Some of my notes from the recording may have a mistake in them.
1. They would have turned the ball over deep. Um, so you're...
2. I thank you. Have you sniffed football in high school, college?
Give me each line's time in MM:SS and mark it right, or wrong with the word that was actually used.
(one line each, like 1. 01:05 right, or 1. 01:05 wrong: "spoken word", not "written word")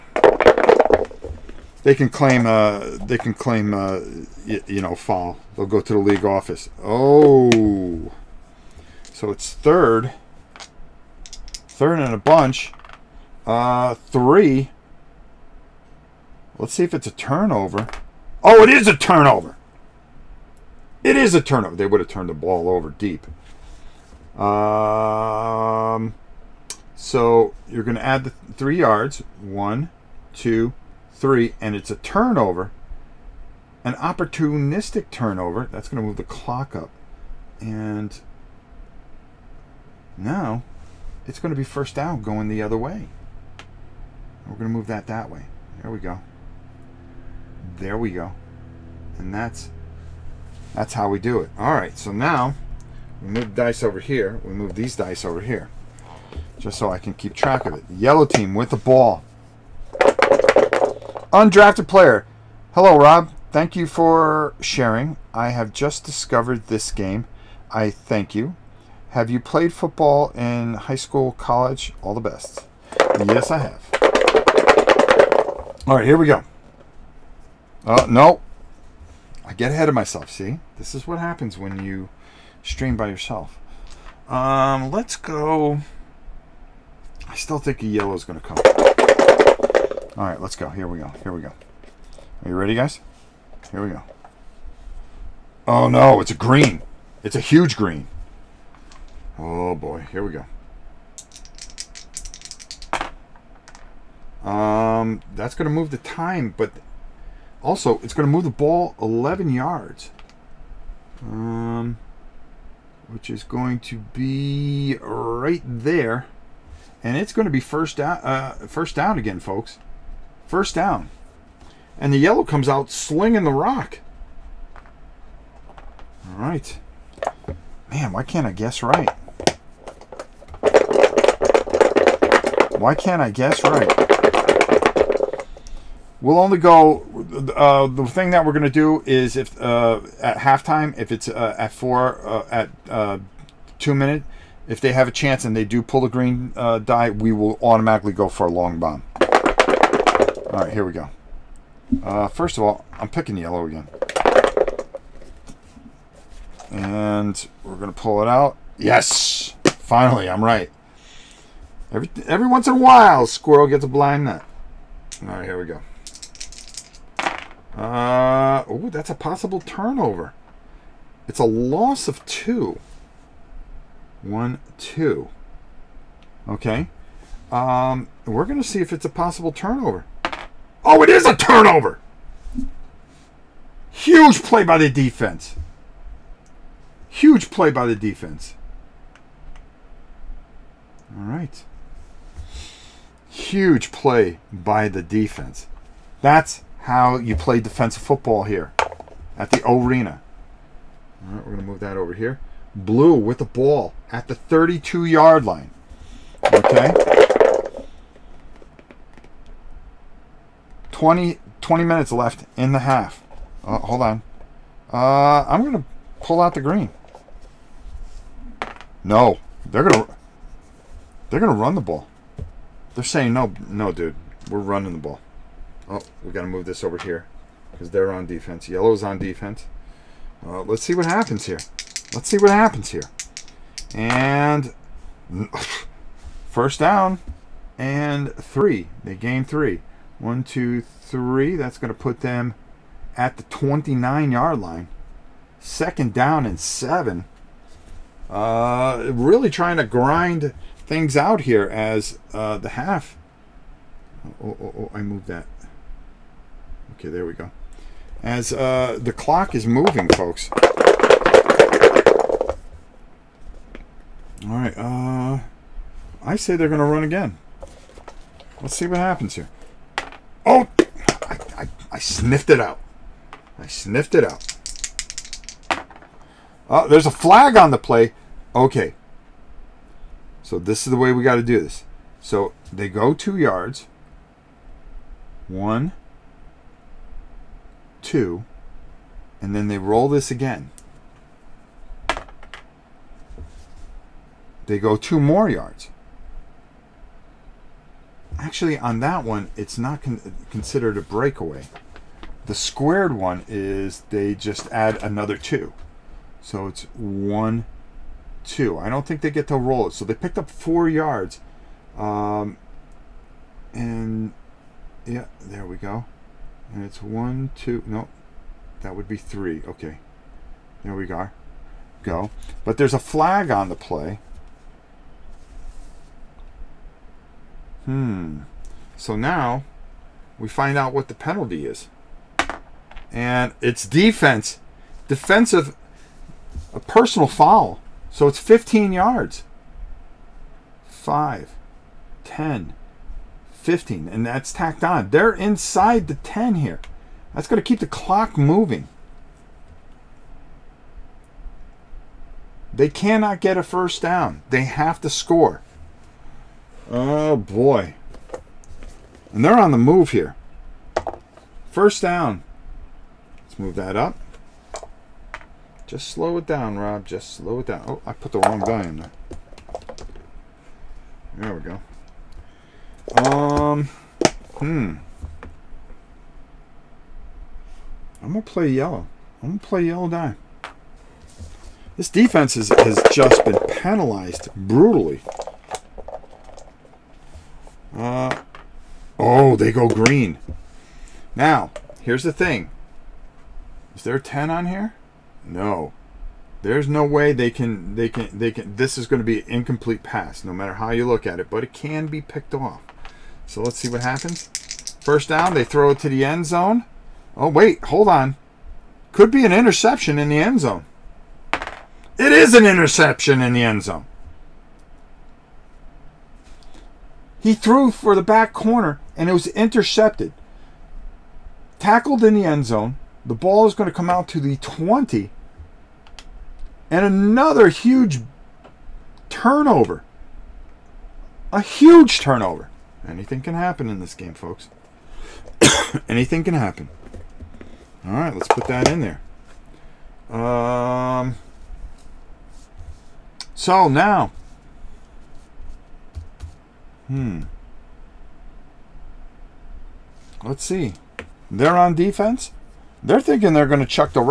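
1. 00:21 right
2. 01:07 wrong: "played", not "sniffed".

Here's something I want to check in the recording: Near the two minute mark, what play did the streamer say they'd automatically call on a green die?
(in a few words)
Long bomb.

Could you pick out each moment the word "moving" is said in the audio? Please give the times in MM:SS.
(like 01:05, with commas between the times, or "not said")
04:19, 05:48.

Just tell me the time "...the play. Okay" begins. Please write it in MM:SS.
04:37.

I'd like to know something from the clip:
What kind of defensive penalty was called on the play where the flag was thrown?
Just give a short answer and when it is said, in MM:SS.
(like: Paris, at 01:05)
Personal foul, at 05:36.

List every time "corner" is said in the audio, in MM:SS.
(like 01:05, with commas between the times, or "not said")
06:58.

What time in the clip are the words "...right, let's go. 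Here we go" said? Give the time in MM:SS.
01:30.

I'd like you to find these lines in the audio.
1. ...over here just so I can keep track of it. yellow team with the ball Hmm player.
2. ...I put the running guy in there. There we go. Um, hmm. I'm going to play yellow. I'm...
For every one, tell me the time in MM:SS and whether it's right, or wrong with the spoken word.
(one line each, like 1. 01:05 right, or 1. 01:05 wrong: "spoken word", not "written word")
1. 00:55 wrong: "Undrafted", not "Hmm"
2. 06:08 wrong: "wrong", not "running".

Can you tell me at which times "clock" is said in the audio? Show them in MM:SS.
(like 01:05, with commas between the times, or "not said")
00:36, 04:19, 05:47.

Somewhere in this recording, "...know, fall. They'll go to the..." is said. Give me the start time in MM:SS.
00:04.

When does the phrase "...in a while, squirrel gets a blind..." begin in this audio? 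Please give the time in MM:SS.
02:42.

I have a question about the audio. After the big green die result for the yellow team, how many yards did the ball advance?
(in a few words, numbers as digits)
11.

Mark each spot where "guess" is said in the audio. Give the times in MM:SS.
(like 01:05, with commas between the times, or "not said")
02:08, 02:13.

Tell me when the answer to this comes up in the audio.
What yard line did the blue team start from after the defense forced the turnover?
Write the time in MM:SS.
03:24.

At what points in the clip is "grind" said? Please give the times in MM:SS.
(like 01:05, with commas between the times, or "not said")
04:09.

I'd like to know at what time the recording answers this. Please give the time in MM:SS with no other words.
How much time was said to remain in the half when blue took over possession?
03:31.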